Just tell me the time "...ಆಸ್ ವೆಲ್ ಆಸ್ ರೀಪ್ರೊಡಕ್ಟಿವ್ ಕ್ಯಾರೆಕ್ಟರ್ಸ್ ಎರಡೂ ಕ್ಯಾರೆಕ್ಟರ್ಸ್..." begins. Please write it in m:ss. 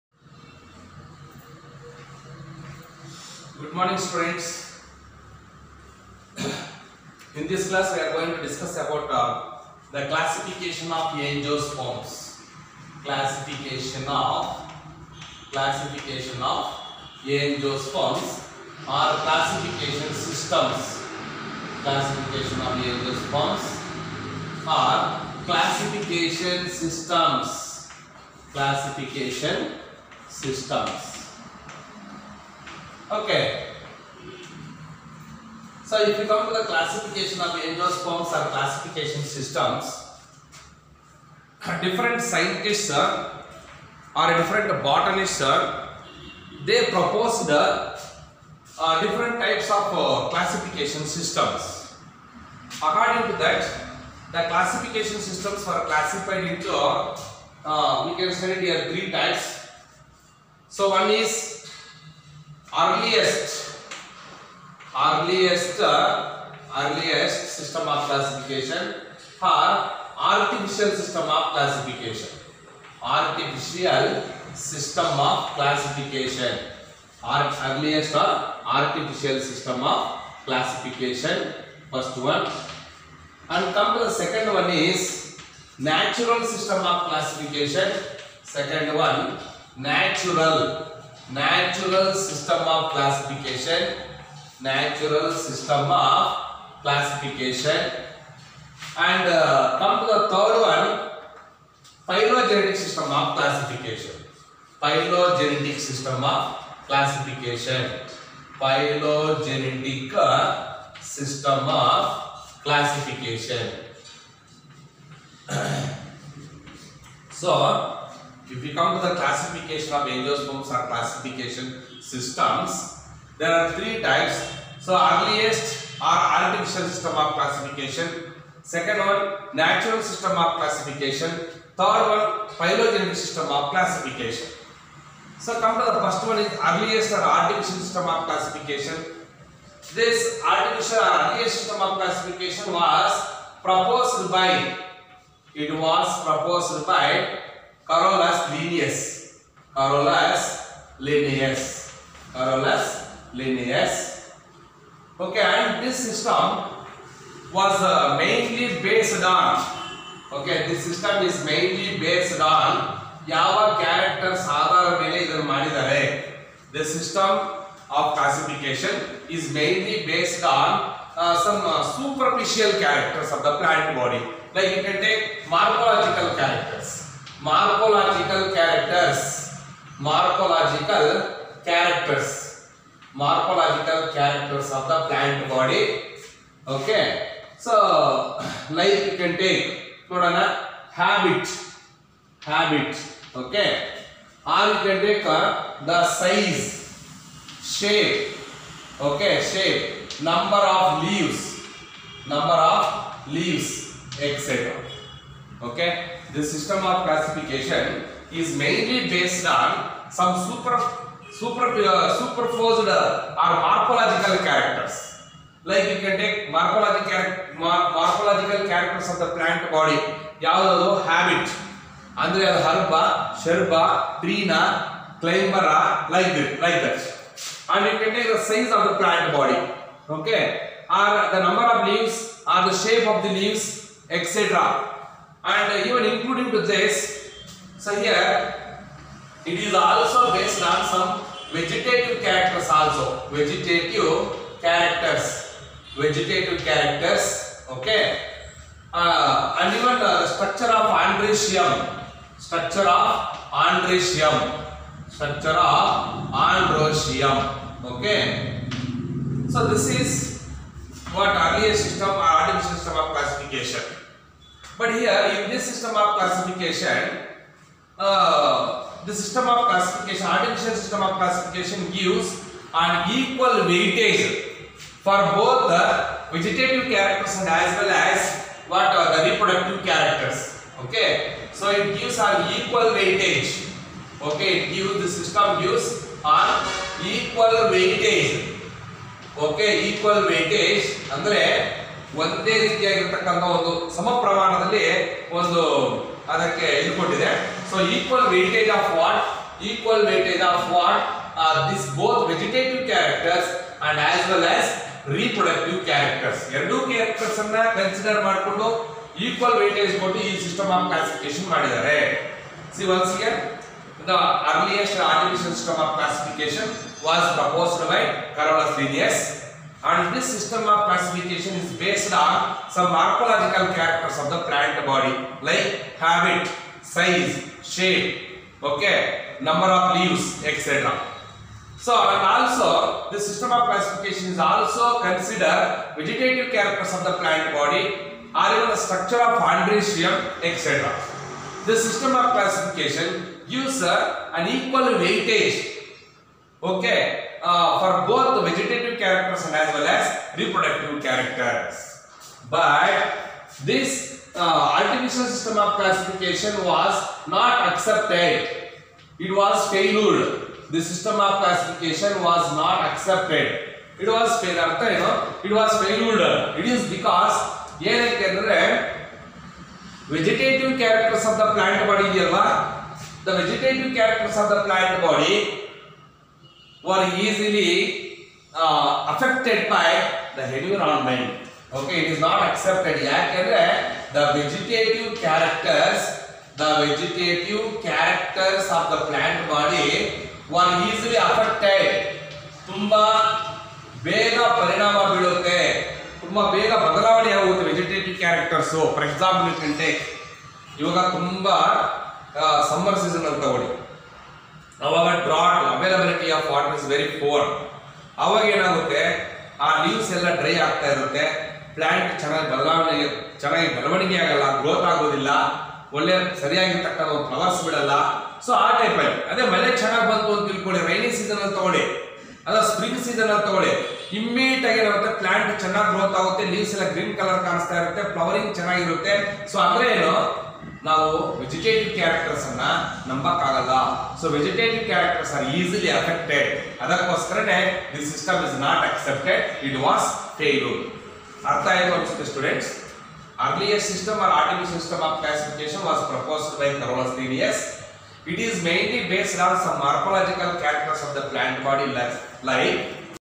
5:04.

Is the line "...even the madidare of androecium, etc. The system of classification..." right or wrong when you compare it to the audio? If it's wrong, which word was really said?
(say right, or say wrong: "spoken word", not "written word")
wrong: "structure", not "madidare".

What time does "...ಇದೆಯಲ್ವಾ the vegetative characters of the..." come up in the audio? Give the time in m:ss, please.
6:12.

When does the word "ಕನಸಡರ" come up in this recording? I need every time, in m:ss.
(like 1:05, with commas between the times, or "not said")
5:07.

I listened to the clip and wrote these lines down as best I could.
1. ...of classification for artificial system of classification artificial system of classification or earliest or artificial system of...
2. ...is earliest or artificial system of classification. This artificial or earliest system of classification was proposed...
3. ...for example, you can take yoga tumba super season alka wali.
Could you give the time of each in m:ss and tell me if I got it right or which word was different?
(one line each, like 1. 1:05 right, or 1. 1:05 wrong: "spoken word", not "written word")
1. 1:07 right
2. 2:16 right
3. 6:38 wrong: "summer", not "super".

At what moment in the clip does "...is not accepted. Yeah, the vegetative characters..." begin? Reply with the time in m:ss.
6:22.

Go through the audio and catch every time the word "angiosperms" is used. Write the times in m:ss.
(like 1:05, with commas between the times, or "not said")
0:11, 0:17, 0:22, 2:00.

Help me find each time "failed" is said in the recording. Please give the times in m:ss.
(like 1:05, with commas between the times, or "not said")
5:59, 6:04.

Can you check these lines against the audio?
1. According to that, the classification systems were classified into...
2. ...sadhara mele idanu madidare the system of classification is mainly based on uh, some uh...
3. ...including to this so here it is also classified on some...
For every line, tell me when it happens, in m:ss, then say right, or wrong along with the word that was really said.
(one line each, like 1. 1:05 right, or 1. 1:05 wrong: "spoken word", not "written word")
1. 0:52 right
2. 2:44 right
3. 3:56 wrong: "based", not "classified".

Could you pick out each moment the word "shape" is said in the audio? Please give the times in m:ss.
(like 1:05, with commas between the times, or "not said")
3:52, 5:27.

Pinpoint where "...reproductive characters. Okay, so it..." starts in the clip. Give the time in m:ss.
4:39.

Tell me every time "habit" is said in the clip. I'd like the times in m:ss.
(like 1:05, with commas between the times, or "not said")
3:41, 5:25.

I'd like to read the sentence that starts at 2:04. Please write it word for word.
So earliest or artificial system of classification.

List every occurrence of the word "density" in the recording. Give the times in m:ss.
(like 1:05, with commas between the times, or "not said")
not said.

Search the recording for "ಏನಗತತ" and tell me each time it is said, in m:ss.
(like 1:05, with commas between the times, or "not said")
6:48, 7:04.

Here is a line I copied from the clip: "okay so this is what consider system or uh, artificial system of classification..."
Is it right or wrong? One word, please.
wrong.